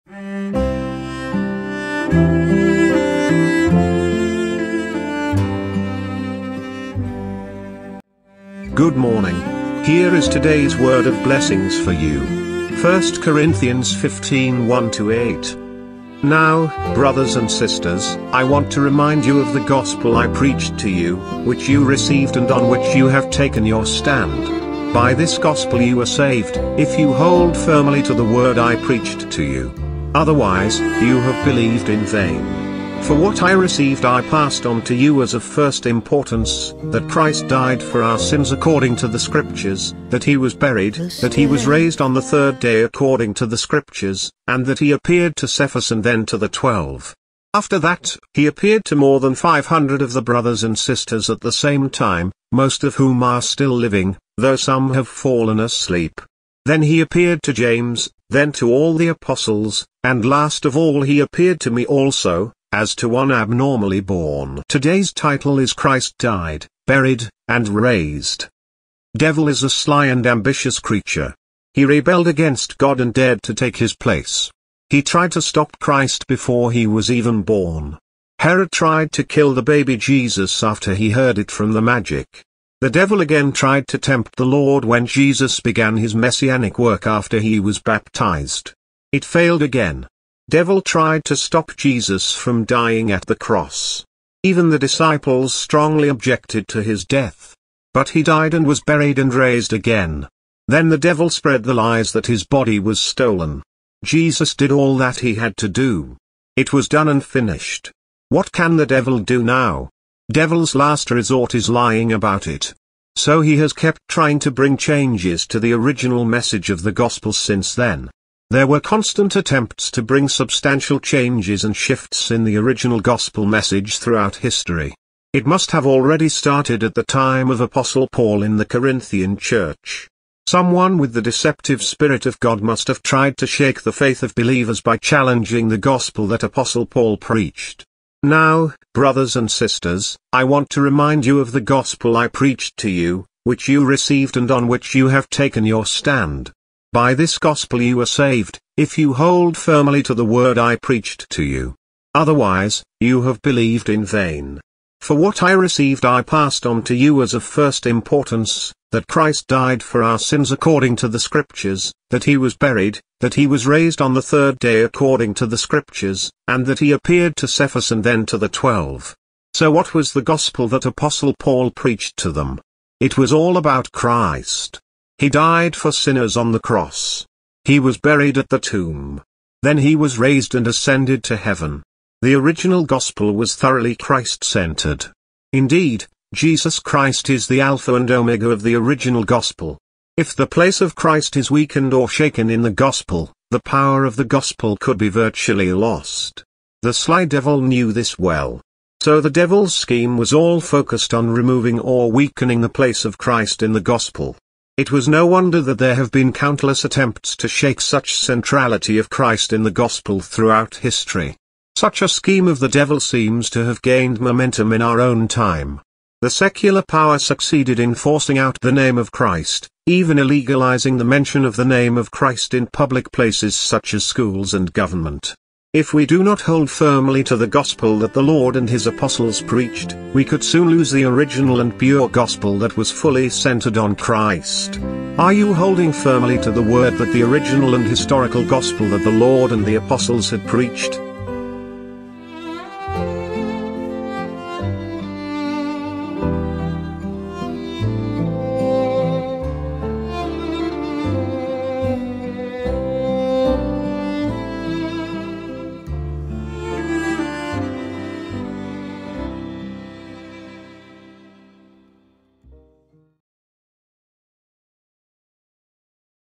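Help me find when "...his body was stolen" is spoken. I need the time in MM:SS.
01:42.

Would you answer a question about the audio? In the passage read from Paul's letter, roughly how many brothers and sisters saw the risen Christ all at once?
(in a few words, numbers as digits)
500.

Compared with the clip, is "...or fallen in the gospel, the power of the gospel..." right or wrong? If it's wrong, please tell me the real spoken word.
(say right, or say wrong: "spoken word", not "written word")
wrong: "shaken", not "fallen".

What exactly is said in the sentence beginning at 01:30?
Devil tried to stop Jesus from dying at the cross.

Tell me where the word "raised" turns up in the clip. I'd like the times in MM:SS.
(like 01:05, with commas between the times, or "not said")
00:41, 01:07, 01:39, 02:43, 03:00.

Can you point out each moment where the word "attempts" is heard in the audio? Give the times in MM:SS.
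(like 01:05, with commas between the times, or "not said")
01:59, 03:26.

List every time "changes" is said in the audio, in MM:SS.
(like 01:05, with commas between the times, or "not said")
01:54, 02:01.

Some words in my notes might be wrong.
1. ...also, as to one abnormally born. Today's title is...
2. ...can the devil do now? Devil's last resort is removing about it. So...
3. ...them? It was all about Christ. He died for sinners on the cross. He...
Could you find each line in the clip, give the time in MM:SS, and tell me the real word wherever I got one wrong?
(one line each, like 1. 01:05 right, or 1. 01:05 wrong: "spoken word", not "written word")
1. 01:01 right
2. 01:48 wrong: "lying", not "removing"
3. 02:52 right.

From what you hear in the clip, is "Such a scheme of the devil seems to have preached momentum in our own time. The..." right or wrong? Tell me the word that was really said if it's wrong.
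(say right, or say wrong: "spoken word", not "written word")
wrong: "gained", not "preached".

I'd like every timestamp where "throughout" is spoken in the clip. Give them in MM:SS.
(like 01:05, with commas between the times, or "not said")
02:03, 03:30.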